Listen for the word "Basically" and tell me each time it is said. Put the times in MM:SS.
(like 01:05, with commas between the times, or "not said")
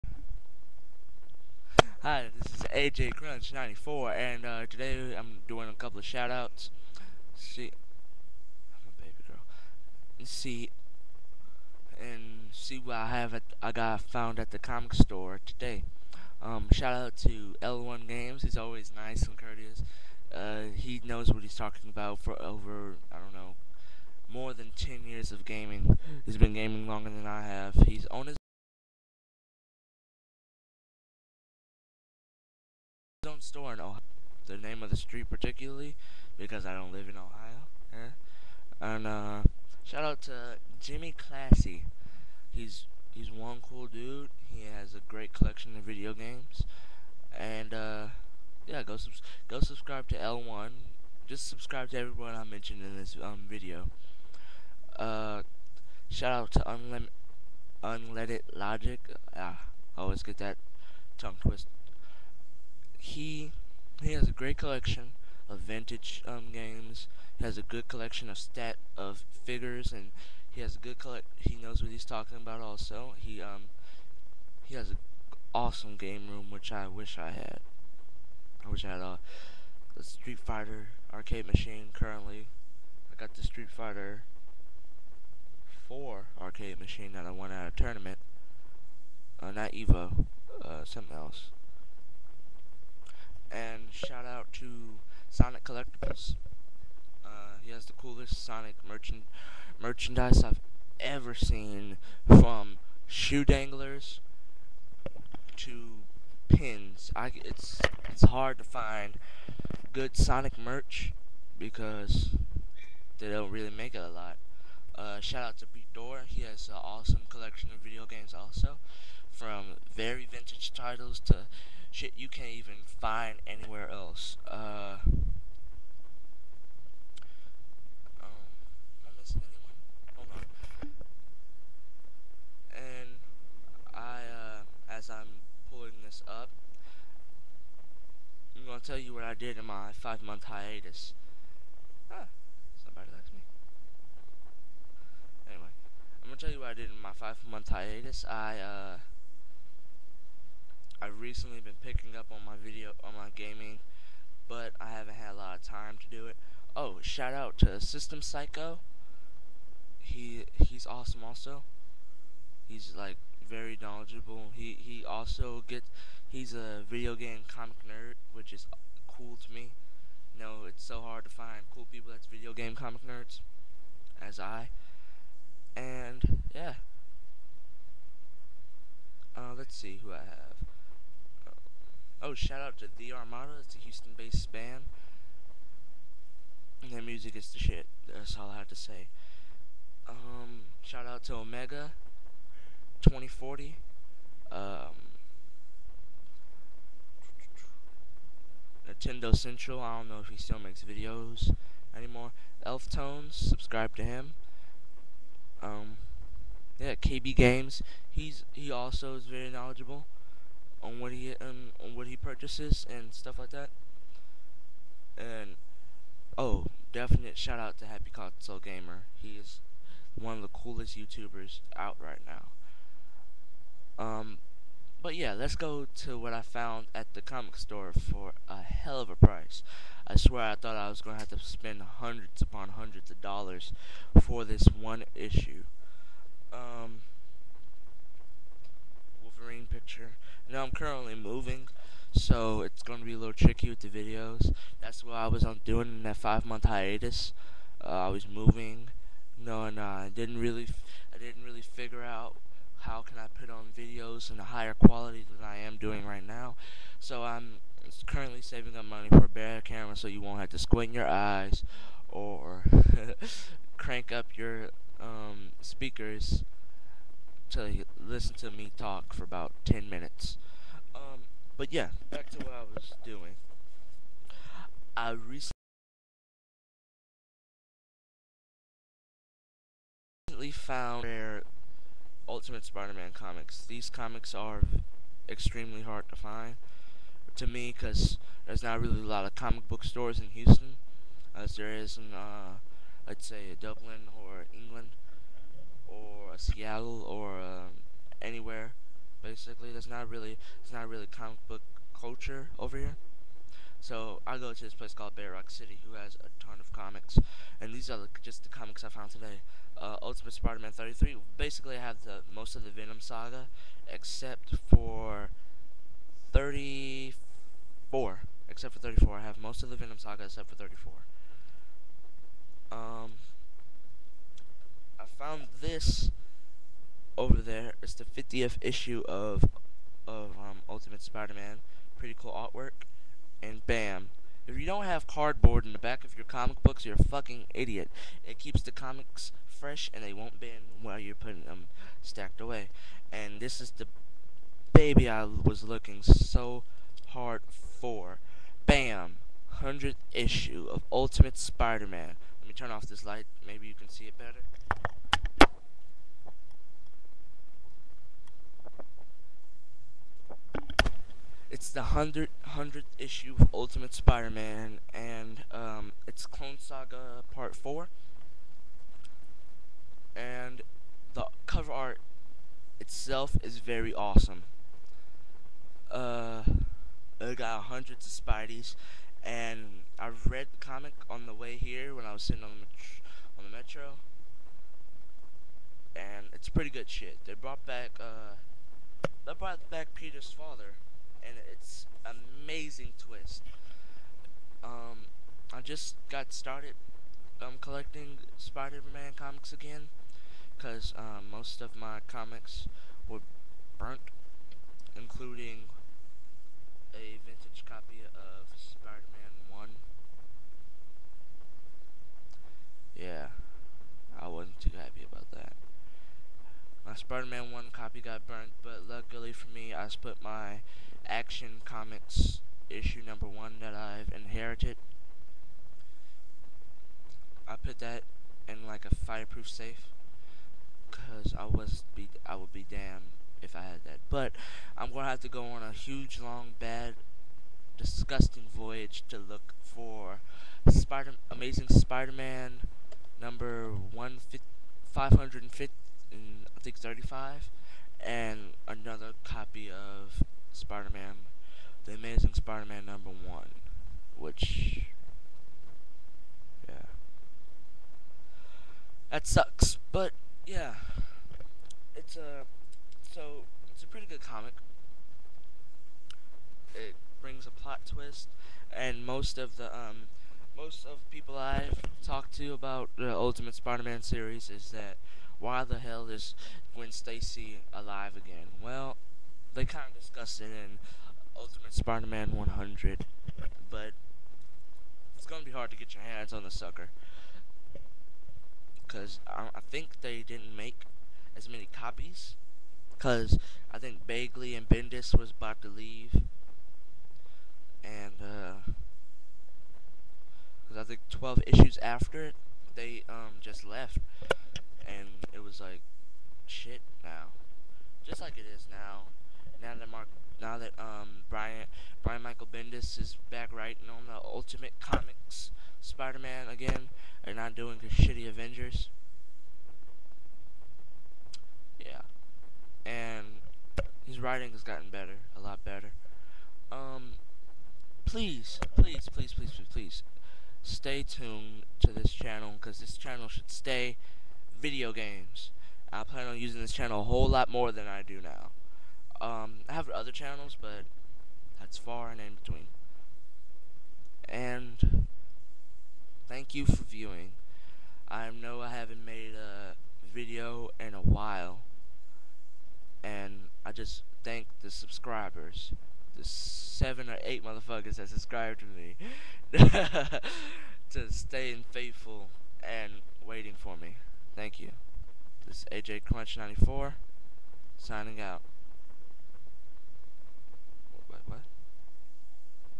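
04:59, 05:11.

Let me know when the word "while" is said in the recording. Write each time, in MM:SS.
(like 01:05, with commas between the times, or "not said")
05:40, 09:11.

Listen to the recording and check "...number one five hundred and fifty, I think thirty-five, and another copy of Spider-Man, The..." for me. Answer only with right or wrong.
right.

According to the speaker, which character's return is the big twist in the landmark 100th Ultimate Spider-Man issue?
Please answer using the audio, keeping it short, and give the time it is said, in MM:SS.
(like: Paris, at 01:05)
Peter's father, at 06:29.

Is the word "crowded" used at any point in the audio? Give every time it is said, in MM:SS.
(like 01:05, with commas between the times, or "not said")
not said.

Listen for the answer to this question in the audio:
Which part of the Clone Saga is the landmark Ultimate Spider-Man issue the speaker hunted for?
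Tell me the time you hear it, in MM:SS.
06:07.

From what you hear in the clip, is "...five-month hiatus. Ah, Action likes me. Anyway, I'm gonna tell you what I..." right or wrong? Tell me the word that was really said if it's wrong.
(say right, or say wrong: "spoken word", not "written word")
wrong: "Somebody", not "Action".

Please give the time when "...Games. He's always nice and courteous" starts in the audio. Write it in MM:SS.
00:18.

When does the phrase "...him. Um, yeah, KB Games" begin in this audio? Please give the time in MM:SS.
03:24.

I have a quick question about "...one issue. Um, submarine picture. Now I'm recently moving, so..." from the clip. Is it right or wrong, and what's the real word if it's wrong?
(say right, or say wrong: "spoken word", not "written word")
wrong: "currently", not "recently".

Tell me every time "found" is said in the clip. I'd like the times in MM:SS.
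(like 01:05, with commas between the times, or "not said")
00:14, 03:46, 04:40, 05:08.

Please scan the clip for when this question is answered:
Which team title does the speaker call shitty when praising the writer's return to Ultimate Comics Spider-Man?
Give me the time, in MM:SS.
08:38.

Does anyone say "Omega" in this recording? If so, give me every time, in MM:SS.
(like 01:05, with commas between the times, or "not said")
03:11.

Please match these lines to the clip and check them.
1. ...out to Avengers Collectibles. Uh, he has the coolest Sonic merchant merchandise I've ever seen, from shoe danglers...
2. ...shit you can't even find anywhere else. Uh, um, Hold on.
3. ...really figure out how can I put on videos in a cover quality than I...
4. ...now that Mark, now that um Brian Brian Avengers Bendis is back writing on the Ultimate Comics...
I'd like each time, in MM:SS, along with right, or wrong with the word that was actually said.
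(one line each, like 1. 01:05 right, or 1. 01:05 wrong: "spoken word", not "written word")
1. 01:34 wrong: "Sonic", not "Avengers"
2. 02:01 right
3. 04:11 wrong: "higher", not "cover"
4. 08:29 wrong: "Michael", not "Avengers".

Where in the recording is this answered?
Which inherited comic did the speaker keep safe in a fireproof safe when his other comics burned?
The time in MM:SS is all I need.
07:01.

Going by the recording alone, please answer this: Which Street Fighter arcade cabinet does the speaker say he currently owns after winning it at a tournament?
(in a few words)
Street Fighter 4.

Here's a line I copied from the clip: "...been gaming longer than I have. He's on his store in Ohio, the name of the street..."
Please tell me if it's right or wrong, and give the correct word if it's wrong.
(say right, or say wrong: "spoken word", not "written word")
right.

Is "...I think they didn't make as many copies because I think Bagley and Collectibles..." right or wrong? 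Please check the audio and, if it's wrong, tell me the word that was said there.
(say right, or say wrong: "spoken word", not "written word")
wrong: "Bendis", not "Collectibles".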